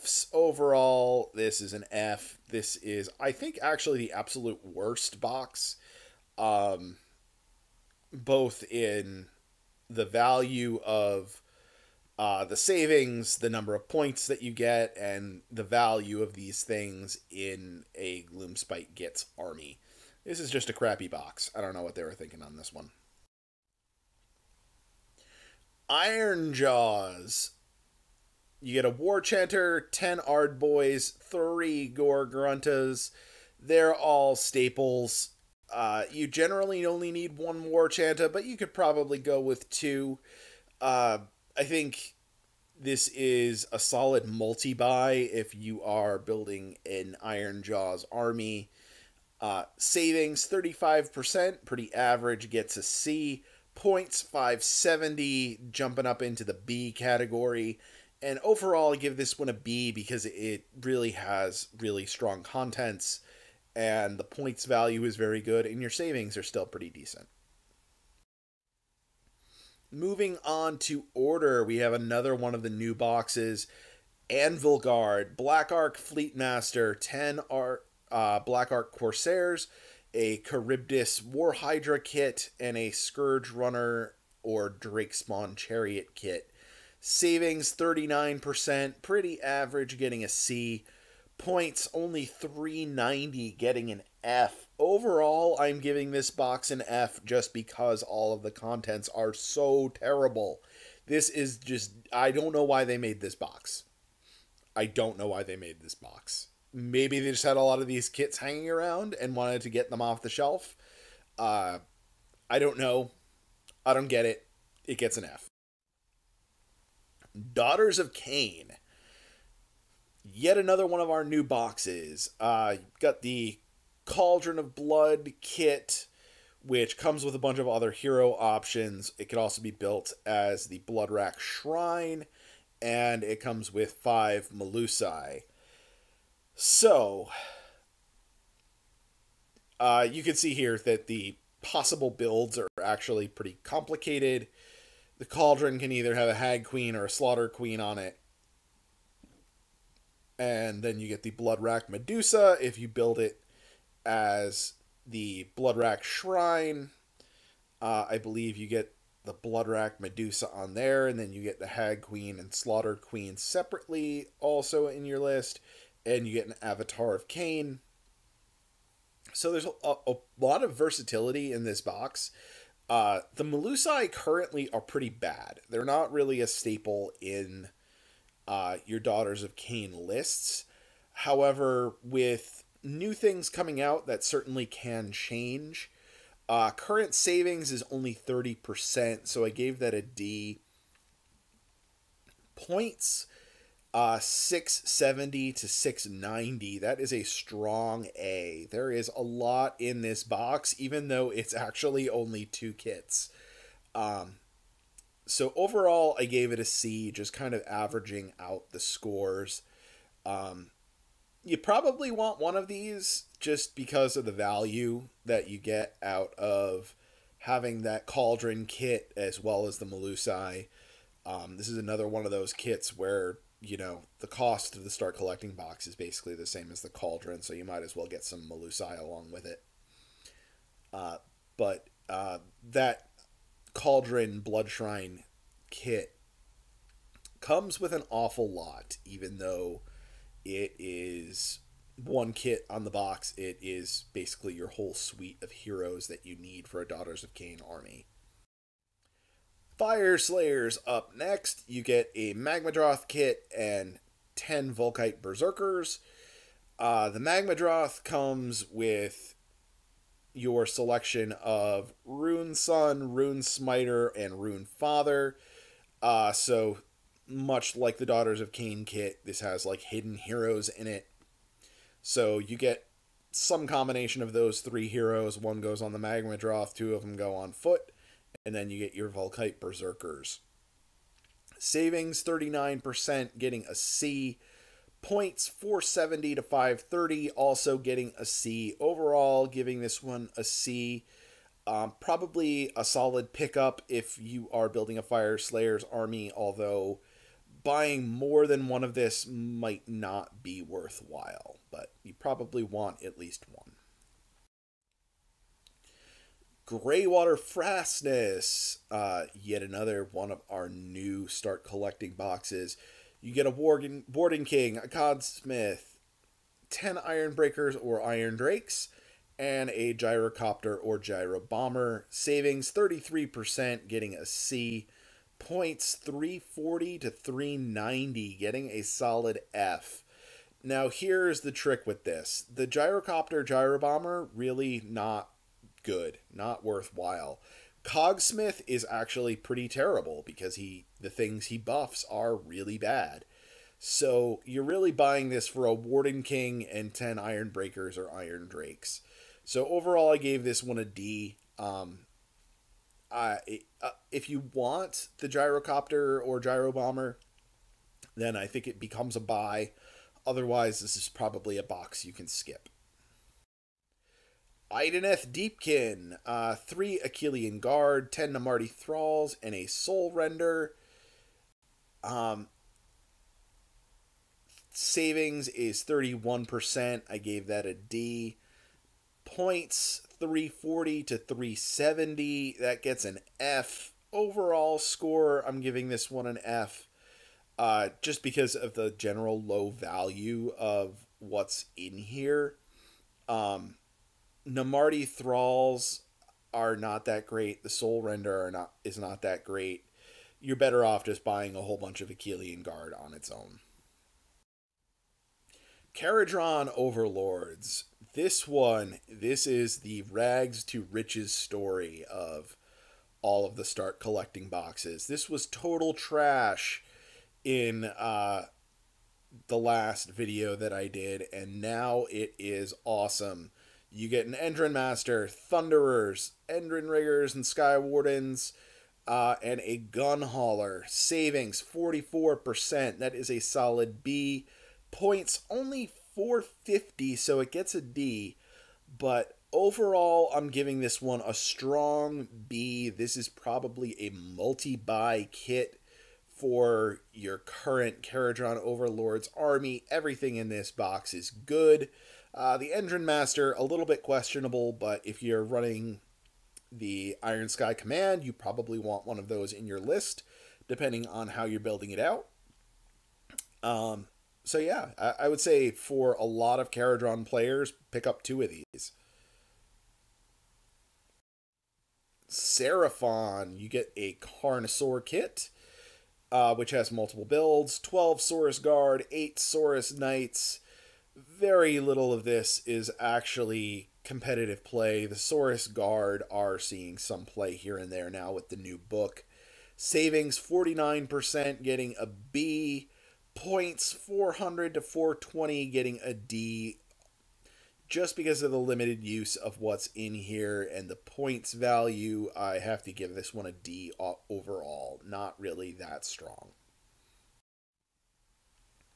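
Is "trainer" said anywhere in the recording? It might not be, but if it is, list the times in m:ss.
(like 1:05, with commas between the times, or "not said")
not said.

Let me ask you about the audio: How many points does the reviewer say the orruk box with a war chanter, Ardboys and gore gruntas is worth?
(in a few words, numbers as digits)
570.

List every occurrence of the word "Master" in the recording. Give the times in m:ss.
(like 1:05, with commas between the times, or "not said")
1:16, 7:04, 7:33.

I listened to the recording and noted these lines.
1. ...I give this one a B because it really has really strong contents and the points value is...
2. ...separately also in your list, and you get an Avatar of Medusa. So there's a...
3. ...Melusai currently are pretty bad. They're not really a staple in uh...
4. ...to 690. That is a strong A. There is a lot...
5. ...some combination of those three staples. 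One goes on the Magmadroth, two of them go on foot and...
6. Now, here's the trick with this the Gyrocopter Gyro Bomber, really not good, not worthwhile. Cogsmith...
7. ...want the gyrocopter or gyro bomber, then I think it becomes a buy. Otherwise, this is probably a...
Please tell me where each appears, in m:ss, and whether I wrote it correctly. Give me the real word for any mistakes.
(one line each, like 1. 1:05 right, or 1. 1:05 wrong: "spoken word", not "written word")
1. 0:58 right
2. 2:43 wrong: "Khaine", not "Medusa"
3. 2:53 right
4. 3:15 right
5. 4:33 wrong: "heroes", not "staples"
6. 5:30 right
7. 5:54 right.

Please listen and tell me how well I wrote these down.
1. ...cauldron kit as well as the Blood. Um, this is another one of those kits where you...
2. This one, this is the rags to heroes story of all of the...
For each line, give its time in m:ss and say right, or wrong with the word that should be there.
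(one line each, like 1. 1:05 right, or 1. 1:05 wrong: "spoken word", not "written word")
1. 3:38 wrong: "Melusai", not "Blood"
2. 6:48 wrong: "riches", not "heroes".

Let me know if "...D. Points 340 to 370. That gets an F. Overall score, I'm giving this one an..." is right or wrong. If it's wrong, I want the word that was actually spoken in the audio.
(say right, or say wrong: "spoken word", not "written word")
right.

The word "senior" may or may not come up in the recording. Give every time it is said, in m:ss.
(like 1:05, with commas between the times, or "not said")
not said.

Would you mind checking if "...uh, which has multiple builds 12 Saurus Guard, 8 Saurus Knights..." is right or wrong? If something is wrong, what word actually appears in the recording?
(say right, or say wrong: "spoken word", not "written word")
right.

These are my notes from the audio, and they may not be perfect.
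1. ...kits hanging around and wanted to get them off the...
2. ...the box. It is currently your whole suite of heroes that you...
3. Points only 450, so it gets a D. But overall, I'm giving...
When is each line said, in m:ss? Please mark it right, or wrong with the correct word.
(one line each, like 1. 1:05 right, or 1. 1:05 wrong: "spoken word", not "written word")
1. 1:48 right
2. 4:02 wrong: "basically", not "currently"
3. 7:14 right.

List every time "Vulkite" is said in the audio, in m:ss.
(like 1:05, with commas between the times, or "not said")
4:14, 4:39.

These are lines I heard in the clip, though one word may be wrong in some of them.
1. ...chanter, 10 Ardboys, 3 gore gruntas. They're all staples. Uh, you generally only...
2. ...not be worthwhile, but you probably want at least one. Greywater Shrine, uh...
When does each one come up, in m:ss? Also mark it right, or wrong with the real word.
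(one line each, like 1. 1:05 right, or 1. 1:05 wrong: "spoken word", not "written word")
1. 0:29 right
2. 4:59 wrong: "Fastness", not "Shrine".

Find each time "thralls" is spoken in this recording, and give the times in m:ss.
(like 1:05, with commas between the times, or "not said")
6:08, 6:35.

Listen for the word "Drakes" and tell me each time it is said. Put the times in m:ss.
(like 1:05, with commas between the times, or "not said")
1:24, 5:18, 5:48.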